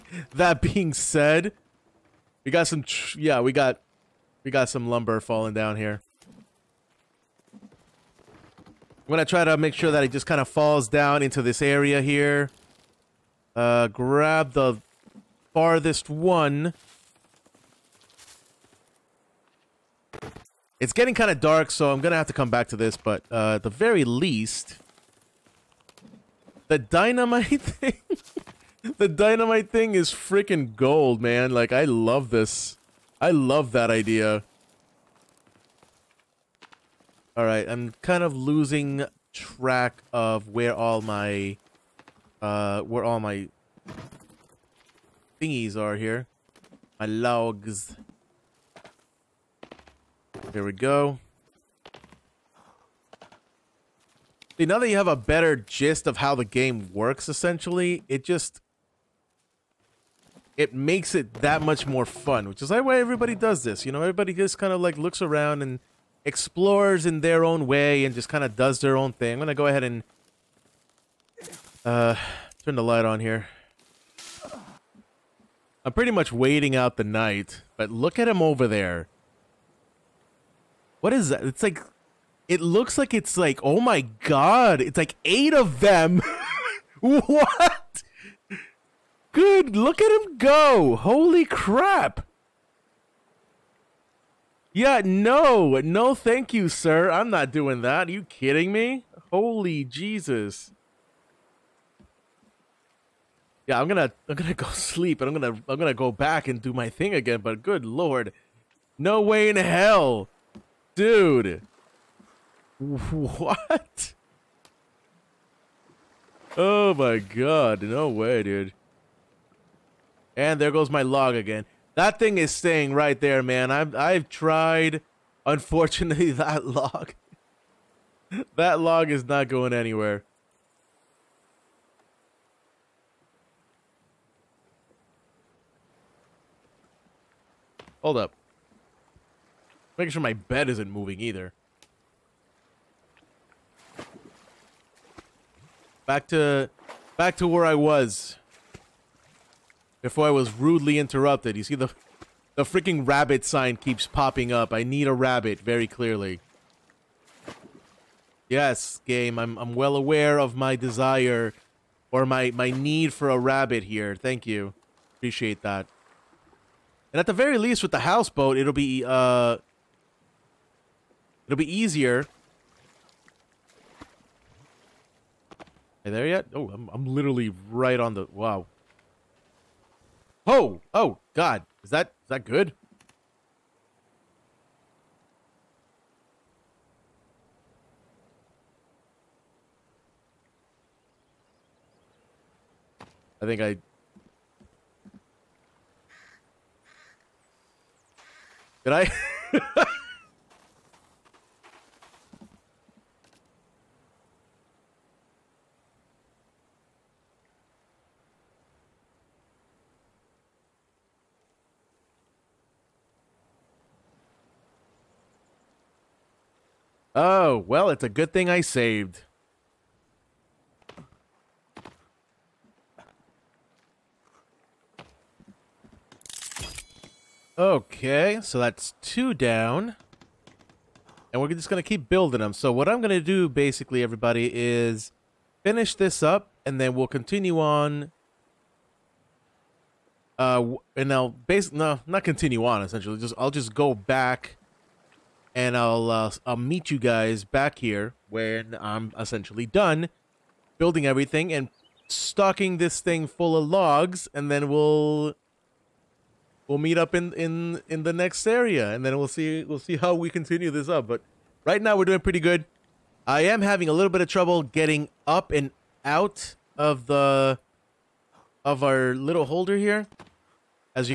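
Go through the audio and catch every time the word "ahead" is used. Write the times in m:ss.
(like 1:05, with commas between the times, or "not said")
1:09.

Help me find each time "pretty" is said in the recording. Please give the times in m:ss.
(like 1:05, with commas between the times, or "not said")
1:15, 4:22.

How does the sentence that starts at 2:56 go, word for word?
Oh, I'm, I'm literally right on the...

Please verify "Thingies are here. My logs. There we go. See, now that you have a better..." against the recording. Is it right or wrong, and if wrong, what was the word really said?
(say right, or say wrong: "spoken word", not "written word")
right.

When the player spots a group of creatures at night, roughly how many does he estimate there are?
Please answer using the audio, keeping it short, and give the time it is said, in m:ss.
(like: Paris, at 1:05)
8, at 1:25.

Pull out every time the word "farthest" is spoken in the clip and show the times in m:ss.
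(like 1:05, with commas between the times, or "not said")
0:15.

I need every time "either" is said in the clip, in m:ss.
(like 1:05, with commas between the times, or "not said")
2:21.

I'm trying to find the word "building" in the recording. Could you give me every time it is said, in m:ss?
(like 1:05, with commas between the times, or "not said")
3:52, 4:10.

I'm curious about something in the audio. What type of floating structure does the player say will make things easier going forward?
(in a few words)
houseboat.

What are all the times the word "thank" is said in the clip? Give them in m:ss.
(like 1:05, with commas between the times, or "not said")
1:36, 2:44.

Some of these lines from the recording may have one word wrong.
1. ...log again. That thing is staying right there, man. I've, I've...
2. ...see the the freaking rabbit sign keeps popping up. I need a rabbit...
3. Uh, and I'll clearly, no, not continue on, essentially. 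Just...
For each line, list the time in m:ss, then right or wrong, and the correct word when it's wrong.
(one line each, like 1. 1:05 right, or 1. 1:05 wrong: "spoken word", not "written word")
1. 2:01 right
2. 2:31 right
3. 4:00 wrong: "basically", not "clearly".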